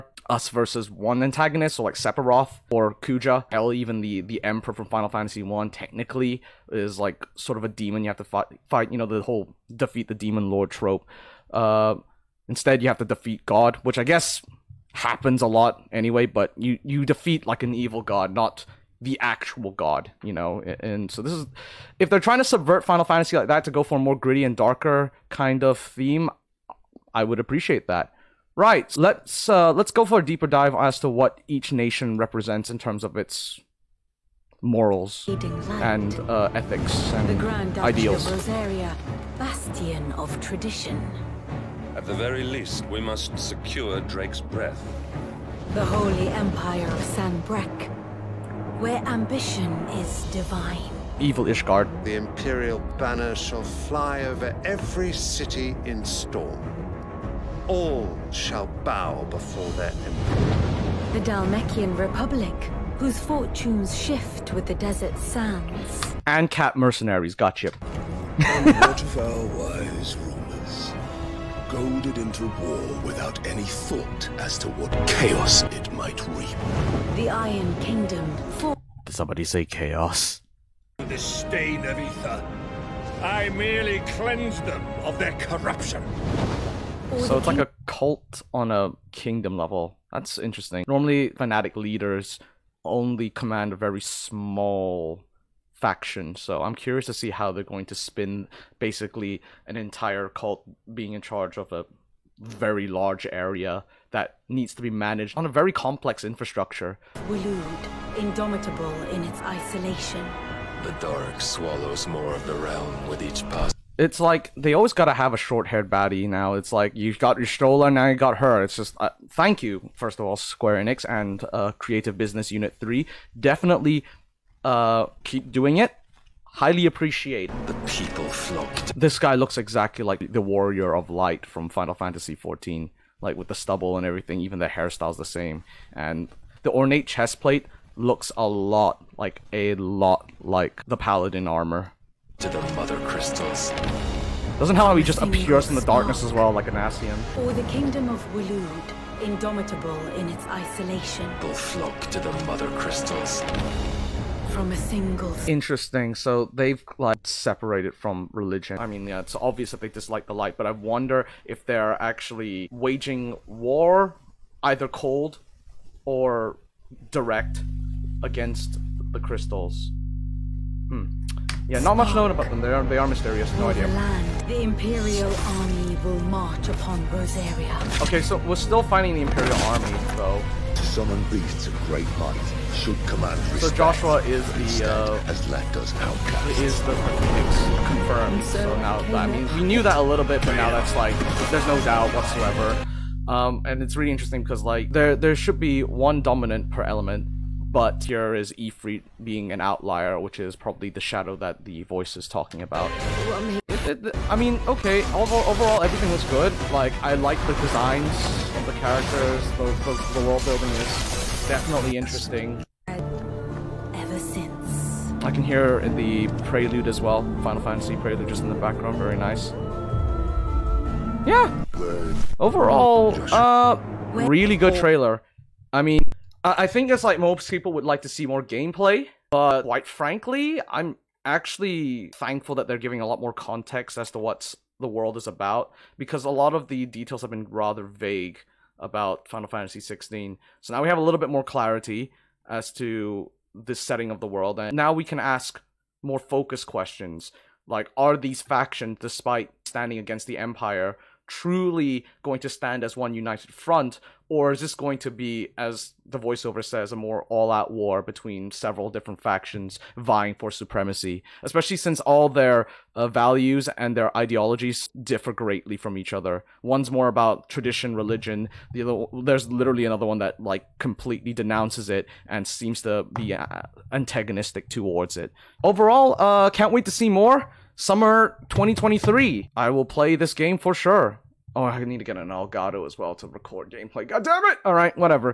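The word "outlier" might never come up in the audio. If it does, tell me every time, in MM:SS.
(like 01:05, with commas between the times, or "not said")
03:19.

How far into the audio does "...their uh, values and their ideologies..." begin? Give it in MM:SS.
04:22.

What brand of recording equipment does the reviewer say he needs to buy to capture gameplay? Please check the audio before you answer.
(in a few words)
Elgato.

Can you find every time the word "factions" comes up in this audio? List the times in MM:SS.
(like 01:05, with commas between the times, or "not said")
01:35, 04:08, 04:19.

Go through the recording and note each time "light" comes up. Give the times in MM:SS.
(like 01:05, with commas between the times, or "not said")
02:11, 02:40.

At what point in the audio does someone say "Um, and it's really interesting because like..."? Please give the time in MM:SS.
03:13.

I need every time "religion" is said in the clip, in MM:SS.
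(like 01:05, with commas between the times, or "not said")
02:38, 04:27.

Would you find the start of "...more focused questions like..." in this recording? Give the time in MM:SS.
04:06.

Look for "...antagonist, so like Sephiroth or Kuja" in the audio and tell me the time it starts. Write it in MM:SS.
00:01.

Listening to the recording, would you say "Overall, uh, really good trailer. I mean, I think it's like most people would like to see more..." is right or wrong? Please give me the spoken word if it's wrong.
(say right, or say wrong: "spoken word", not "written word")
right.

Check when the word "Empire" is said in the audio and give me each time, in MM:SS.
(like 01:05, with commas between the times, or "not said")
00:46, 04:10.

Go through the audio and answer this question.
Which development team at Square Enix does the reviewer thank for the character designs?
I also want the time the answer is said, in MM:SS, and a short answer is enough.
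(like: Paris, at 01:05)
Creative Business Unit 3, at 02:01.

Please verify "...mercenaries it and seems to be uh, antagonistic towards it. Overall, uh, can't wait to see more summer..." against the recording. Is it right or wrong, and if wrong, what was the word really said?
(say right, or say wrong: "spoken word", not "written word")
wrong: "denounces", not "mercenaries".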